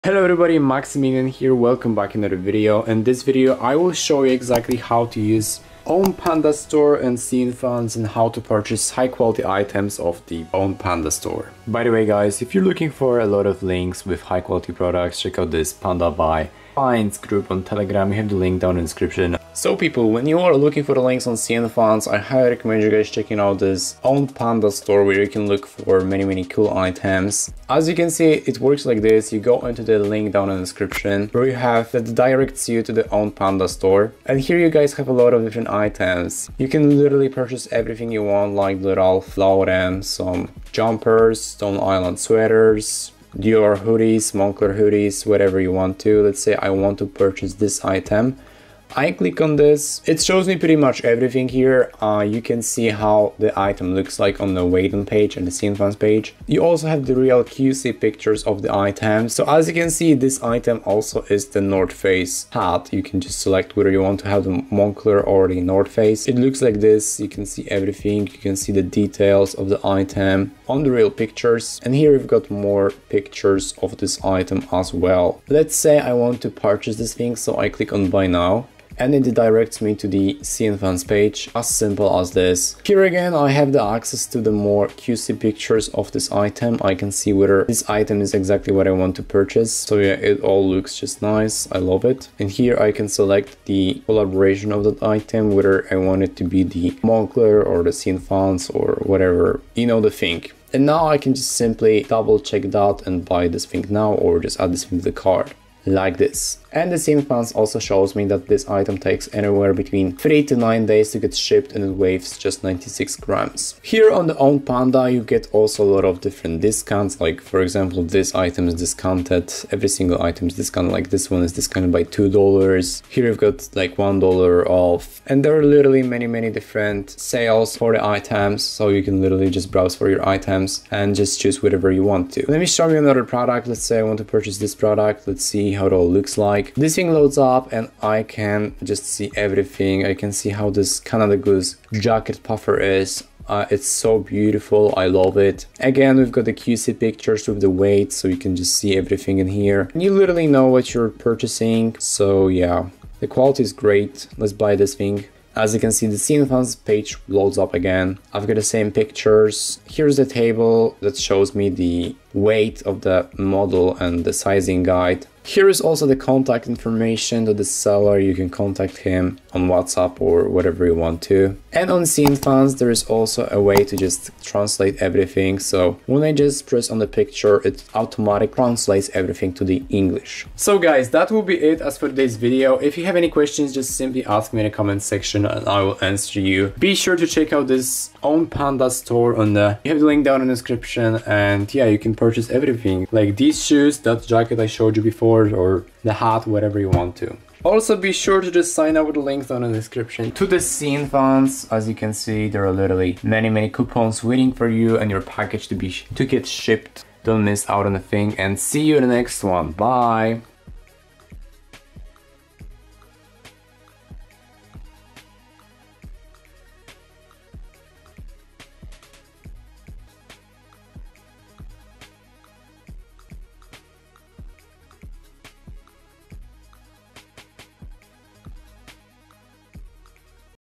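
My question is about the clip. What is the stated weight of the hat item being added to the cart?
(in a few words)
96 grams.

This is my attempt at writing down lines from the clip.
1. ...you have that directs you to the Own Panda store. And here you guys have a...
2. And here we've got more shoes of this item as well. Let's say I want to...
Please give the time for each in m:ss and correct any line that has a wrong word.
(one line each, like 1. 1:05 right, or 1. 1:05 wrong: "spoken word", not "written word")
1. 0:31 right
2. 1:11 wrong: "pictures", not "shoes".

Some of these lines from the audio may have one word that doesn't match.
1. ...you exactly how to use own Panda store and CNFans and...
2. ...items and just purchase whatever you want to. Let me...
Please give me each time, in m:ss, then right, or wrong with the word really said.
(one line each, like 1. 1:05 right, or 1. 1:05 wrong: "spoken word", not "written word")
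1. 0:04 right
2. 2:10 wrong: "choose", not "purchase".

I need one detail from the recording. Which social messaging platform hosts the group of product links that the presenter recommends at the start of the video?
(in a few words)
Telegram.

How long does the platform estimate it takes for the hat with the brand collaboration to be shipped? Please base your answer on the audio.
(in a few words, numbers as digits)
3 to 9 days.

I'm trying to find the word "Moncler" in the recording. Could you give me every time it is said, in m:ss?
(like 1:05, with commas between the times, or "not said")
0:44, 1:04, 1:37.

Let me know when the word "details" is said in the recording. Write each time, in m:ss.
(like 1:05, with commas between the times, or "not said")
1:08.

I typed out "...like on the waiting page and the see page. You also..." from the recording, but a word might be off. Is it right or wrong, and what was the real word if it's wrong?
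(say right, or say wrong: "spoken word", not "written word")
right.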